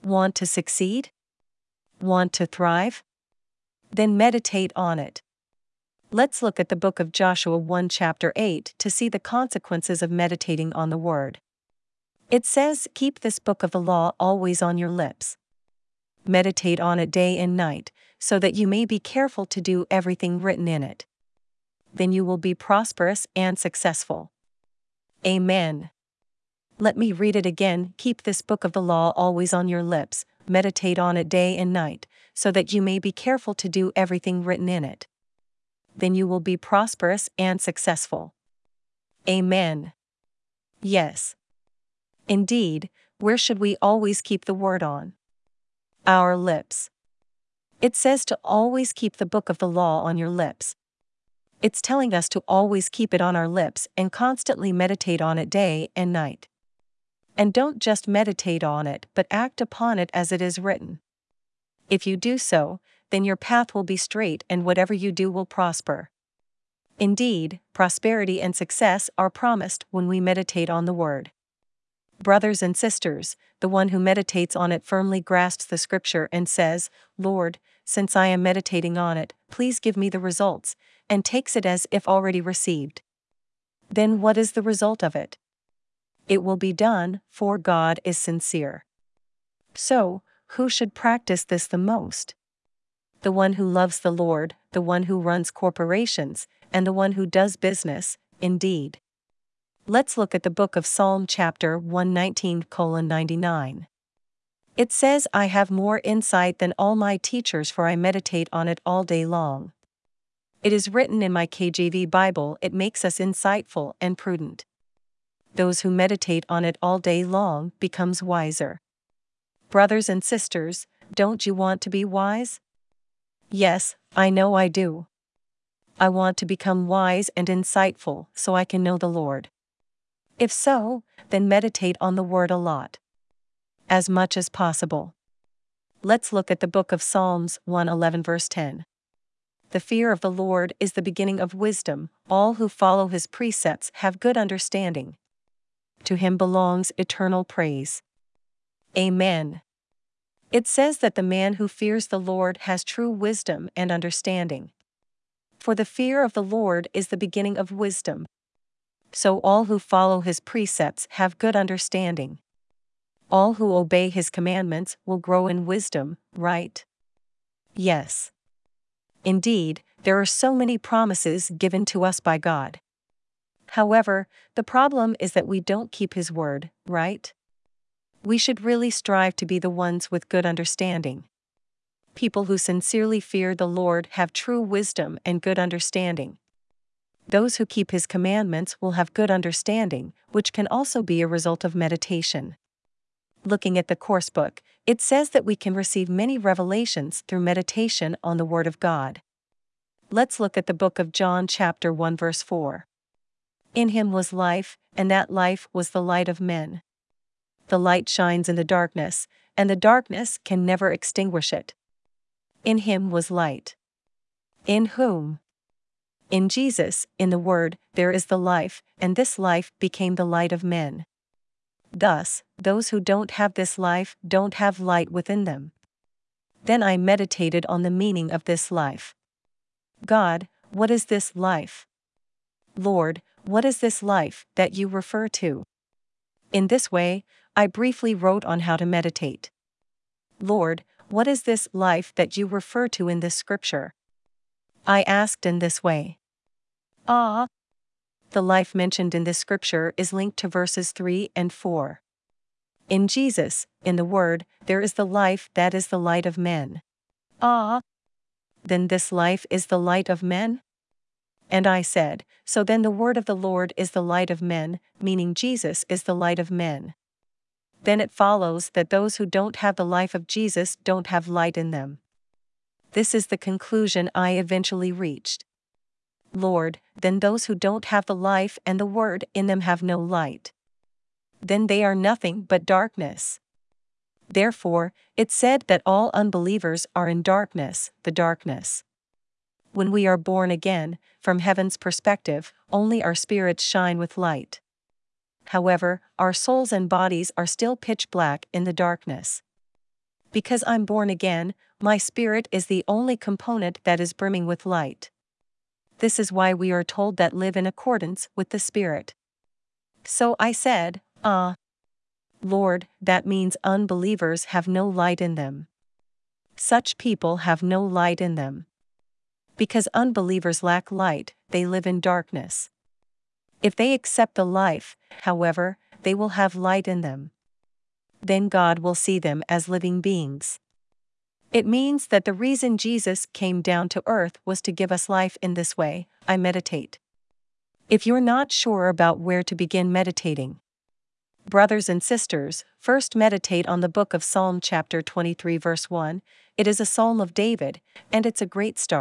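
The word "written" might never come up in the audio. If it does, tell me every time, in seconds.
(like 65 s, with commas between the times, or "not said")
20 s, 34 s, 60 s, 110 s.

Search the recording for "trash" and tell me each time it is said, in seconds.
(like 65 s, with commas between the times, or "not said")
not said.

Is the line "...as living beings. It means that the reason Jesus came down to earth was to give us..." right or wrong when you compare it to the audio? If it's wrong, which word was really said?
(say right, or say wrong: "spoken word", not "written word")
right.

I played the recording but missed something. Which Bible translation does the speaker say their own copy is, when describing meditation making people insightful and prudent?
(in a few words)
KJV.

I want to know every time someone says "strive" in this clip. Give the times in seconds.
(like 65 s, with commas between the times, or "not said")
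178 s.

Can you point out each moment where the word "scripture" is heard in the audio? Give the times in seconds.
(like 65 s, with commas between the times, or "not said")
75 s, 243 s, 249 s.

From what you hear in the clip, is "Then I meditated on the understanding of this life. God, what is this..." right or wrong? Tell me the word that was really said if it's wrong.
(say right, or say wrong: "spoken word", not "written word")
wrong: "meaning", not "understanding".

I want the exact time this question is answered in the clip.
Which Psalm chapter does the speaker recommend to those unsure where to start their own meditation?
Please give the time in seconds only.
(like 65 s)
345 s.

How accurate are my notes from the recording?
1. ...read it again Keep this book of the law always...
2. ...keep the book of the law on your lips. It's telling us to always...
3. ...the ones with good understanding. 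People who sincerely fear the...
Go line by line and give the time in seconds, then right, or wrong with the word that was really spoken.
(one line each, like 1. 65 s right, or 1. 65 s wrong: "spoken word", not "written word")
1. 27 s right
2. 48 s right
3. 179 s right.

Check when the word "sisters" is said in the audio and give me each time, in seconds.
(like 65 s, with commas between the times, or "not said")
72 s, 120 s, 342 s.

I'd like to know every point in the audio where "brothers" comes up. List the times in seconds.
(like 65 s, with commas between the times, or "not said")
72 s, 119 s, 341 s.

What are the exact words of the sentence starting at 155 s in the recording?
For the fear of the Lord is the beginning of wisdom.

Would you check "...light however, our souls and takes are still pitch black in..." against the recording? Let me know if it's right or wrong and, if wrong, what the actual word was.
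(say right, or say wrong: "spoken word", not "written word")
wrong: "bodies", not "takes".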